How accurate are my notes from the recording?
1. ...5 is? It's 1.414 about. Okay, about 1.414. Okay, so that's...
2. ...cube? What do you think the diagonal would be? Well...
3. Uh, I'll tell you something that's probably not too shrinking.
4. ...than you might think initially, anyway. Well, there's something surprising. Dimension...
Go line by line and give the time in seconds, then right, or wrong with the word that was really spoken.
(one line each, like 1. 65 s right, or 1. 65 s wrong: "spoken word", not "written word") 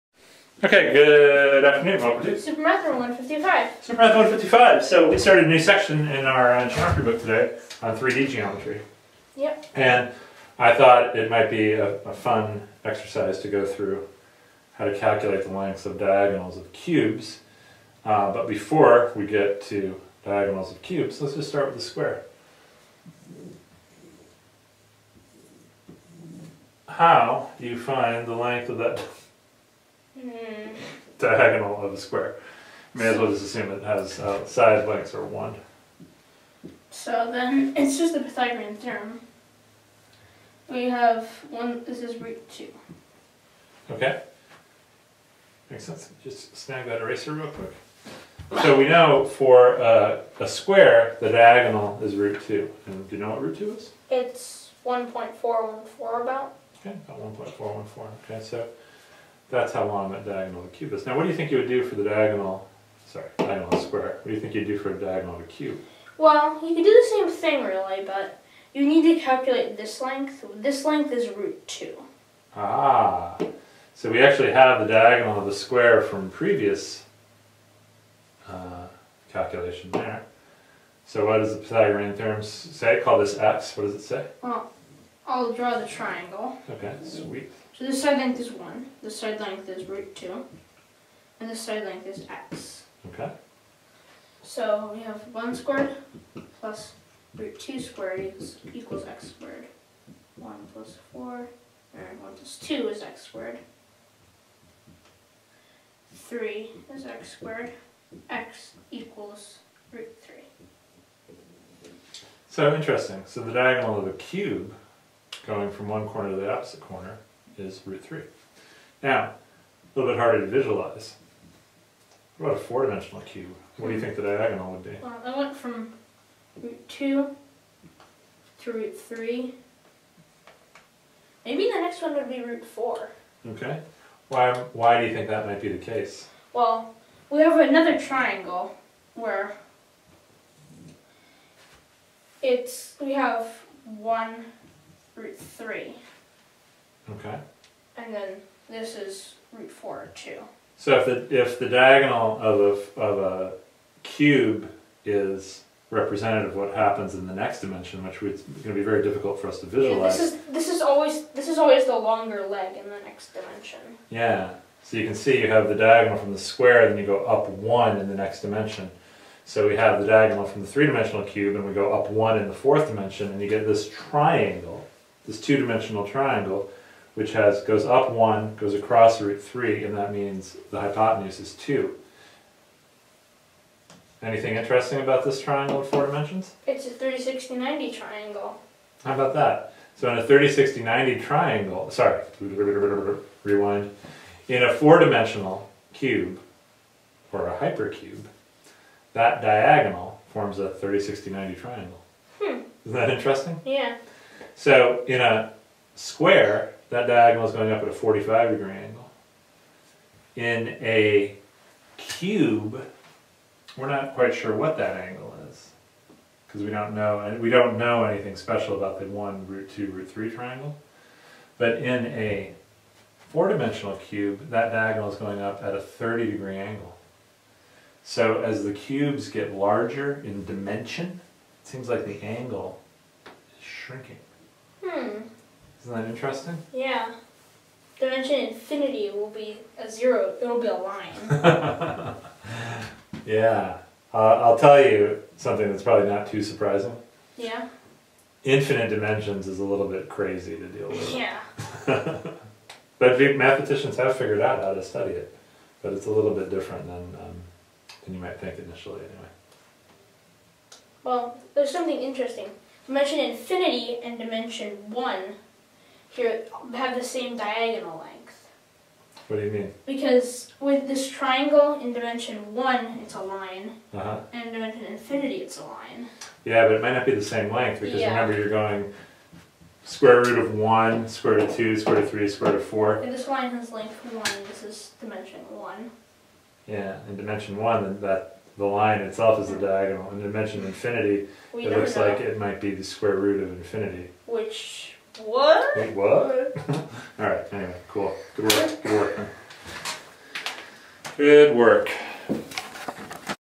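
1. 53 s wrong: "2", not "5"
2. 123 s right
3. 244 s wrong: "surprising", not "shrinking"
4. 258 s wrong: "interesting", not "surprising".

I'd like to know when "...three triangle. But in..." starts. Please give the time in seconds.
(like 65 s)
220 s.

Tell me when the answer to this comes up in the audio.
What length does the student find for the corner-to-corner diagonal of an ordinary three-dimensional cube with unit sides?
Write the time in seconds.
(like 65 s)
108 s.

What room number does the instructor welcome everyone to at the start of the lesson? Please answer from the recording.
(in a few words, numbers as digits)
155.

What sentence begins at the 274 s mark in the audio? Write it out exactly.
and in dimension infinity, it's a line.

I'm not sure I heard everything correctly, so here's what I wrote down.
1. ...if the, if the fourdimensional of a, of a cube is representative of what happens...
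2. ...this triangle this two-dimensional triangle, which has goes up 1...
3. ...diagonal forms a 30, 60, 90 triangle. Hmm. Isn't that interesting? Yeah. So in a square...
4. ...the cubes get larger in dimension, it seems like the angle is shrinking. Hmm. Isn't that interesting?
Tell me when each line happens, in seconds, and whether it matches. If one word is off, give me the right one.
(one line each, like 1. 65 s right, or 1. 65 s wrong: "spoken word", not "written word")
1. 150 s wrong: "diagonal", not "fourdimensional"
2. 173 s right
3. 199 s right
4. 228 s right.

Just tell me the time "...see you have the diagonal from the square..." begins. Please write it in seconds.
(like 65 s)
165 s.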